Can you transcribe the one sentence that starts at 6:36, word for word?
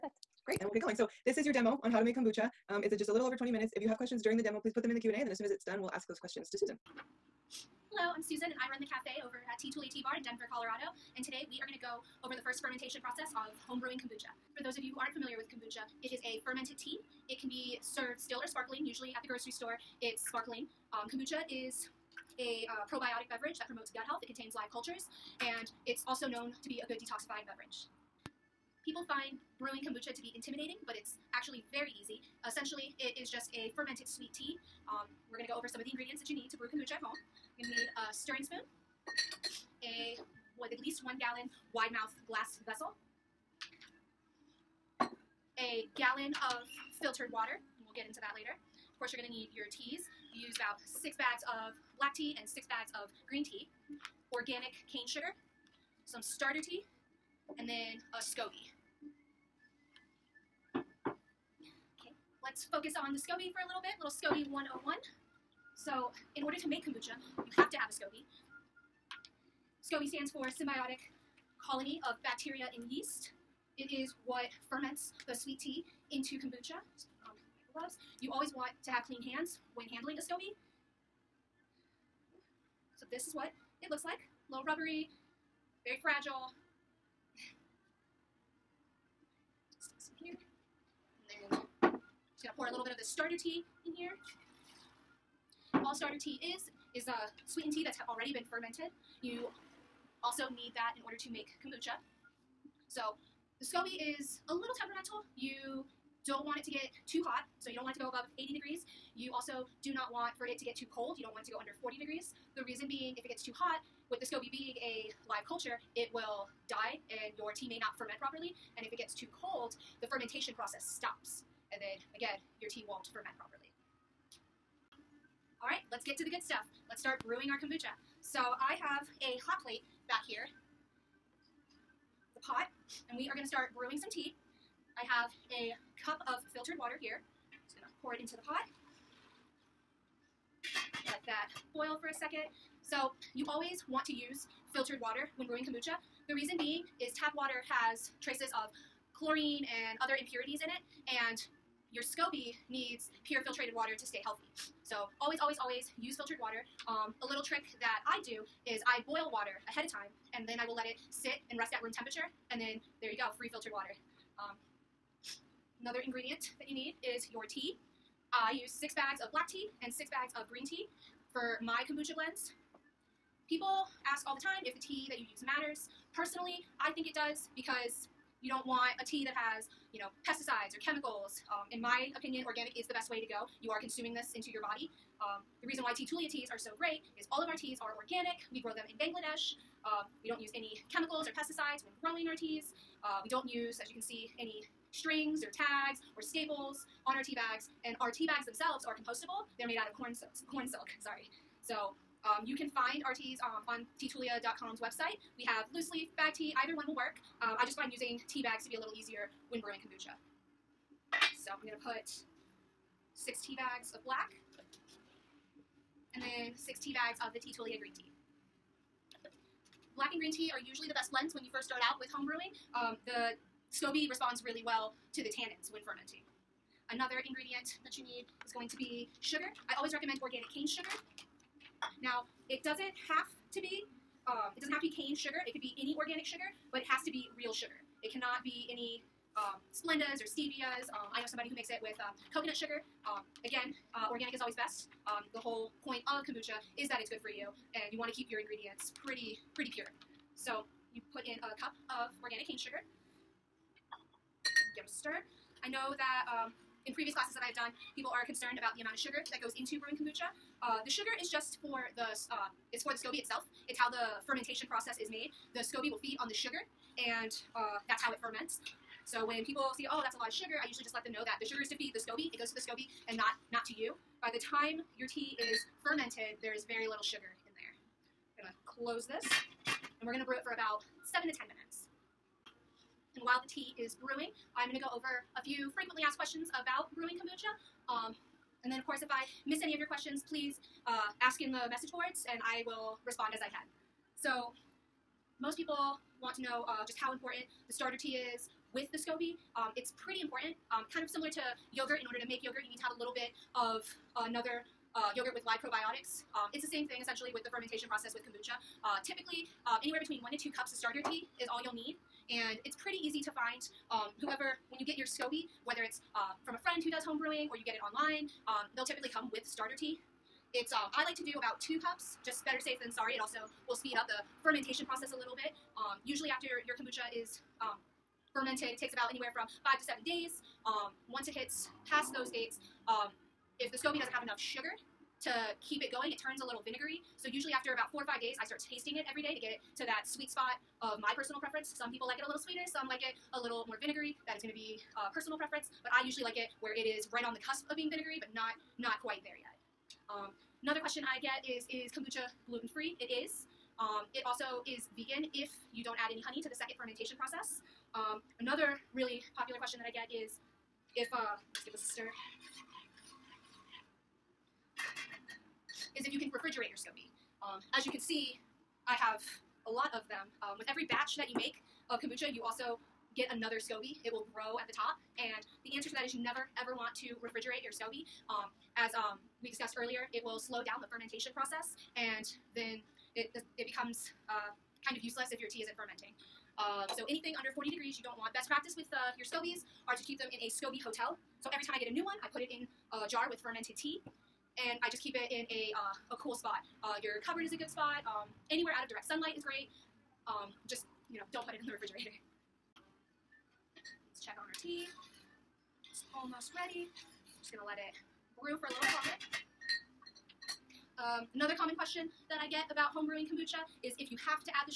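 Uh, your cupboard is a good spot.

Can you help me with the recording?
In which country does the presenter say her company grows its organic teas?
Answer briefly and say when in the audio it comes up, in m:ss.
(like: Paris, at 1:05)
Bangladesh, at 3:09.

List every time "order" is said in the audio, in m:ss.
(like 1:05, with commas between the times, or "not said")
1:06, 1:41, 5:02.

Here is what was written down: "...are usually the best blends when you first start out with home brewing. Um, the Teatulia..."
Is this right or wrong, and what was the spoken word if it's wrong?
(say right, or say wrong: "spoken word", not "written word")
wrong: "SCOBY", not "Teatulia".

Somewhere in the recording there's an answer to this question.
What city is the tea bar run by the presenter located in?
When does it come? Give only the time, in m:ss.
0:10.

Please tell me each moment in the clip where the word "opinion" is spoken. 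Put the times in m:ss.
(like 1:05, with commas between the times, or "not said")
3:02.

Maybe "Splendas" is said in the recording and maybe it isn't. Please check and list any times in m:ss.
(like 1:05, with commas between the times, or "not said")
3:59.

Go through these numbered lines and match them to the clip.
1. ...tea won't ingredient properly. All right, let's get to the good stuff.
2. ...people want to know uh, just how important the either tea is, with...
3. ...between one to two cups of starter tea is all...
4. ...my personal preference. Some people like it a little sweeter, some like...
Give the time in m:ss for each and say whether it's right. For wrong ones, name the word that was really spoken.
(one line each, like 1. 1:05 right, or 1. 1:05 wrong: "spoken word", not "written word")
1. 2:02 wrong: "ferment", not "ingredient"
2. 4:55 wrong: "starter", not "either"
3. 5:09 right
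4. 5:41 right.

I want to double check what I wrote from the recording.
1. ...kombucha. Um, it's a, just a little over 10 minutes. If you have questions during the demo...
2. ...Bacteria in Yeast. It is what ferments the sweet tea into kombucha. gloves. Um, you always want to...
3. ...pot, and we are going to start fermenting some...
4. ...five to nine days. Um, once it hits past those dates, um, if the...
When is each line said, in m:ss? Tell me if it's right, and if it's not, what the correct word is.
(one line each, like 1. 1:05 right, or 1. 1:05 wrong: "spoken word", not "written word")
1. 0:02 wrong: "20", not "10"
2. 1:12 right
3. 2:12 wrong: "brewing", not "fermenting"
4. 5:29 wrong: "seven", not "nine".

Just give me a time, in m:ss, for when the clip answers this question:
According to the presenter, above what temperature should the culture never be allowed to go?
1:48.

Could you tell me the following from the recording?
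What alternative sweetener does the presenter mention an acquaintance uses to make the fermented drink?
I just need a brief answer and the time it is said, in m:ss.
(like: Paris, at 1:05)
coconut sugar, at 4:02.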